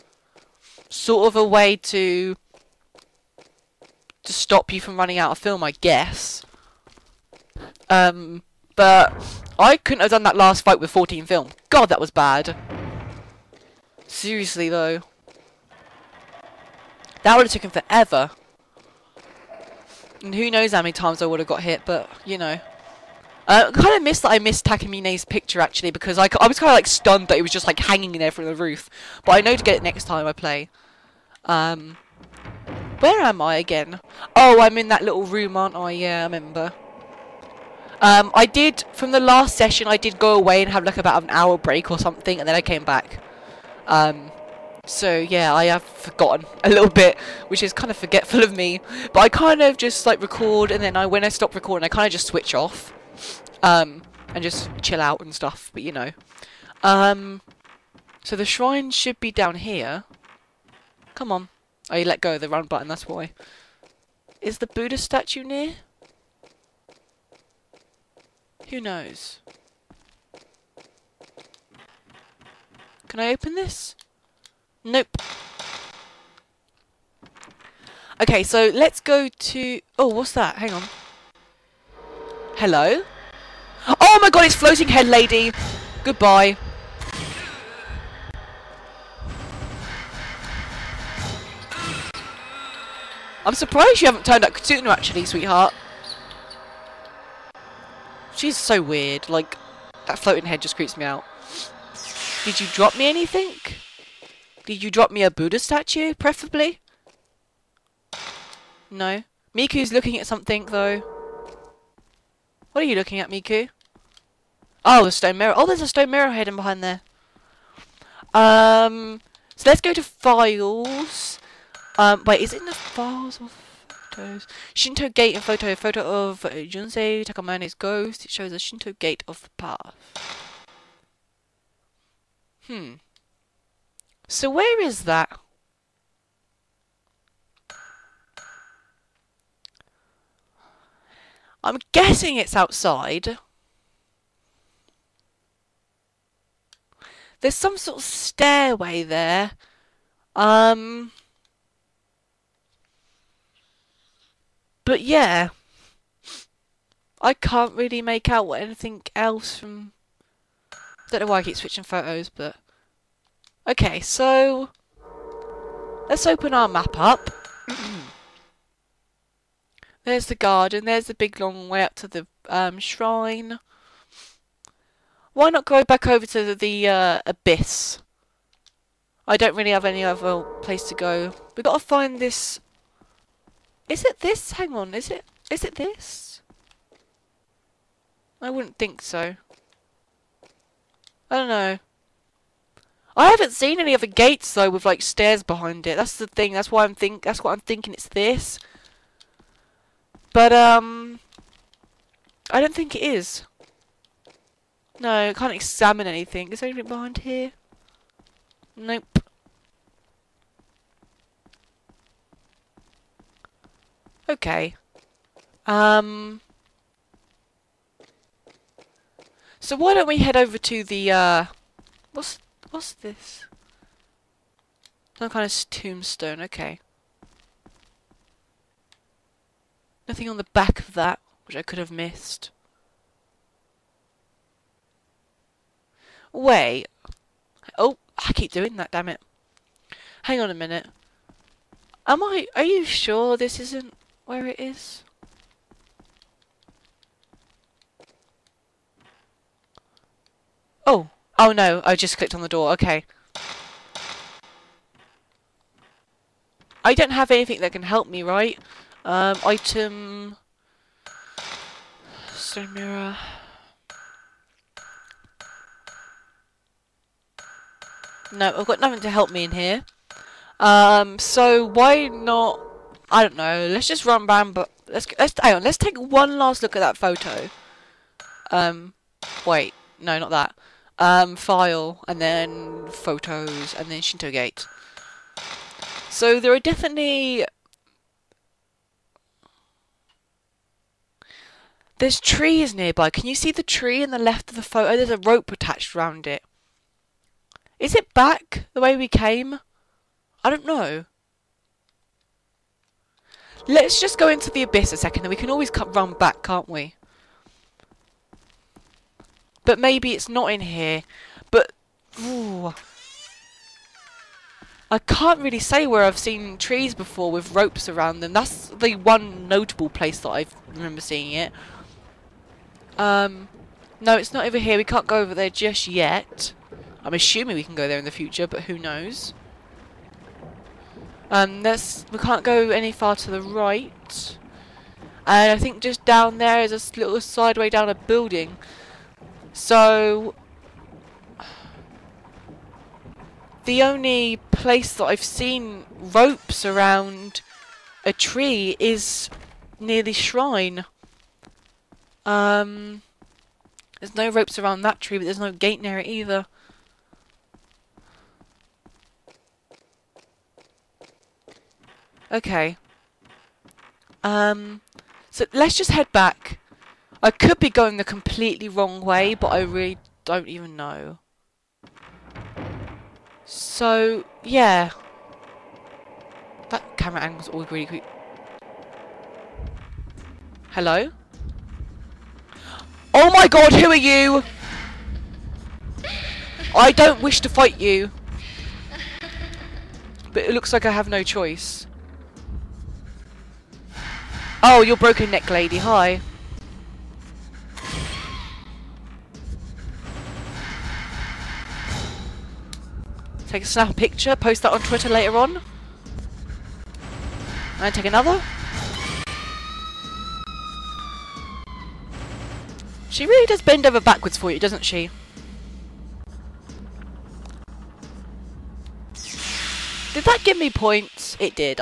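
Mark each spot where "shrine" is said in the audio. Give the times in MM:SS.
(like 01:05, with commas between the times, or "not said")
00:58, 02:52, 05:50.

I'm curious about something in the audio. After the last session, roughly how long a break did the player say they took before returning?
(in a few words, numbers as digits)
About an hour.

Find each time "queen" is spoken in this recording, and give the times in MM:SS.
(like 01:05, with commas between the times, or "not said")
not said.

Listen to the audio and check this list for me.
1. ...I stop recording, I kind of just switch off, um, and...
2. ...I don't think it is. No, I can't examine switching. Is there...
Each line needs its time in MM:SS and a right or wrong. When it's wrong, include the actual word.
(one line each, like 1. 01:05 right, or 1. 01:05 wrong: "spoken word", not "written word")
1. 00:51 right
2. 03:22 wrong: "anything", not "switching".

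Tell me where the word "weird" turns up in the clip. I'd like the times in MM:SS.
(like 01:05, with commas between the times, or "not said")
01:38.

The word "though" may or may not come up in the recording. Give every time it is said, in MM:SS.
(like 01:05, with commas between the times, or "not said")
00:14, 01:50, 03:14.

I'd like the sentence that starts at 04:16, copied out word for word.
I don't have anything that can help me, right?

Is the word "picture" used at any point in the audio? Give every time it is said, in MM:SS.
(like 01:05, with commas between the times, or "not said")
00:25, 06:43.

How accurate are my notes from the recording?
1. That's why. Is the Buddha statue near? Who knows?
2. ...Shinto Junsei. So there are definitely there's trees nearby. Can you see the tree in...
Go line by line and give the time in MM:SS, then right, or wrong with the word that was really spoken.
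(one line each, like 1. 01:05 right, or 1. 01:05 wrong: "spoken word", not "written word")
1. 01:02 right
2. 04:44 wrong: "Gate", not "Junsei".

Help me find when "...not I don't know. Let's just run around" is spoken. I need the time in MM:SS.
04:32.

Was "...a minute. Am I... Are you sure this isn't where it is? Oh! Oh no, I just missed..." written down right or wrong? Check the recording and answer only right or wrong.
wrong.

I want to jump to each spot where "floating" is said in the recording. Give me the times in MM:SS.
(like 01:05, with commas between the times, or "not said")
01:24, 01:40.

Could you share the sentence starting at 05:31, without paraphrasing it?
Um, we can't go any far to the right.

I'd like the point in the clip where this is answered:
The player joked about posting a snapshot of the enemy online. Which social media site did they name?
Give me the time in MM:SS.
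06:44.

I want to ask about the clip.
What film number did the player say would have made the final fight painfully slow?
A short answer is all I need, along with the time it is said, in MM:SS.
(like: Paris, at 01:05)
14, at 00:10.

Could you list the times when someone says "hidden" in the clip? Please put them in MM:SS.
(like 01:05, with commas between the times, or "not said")
01:56.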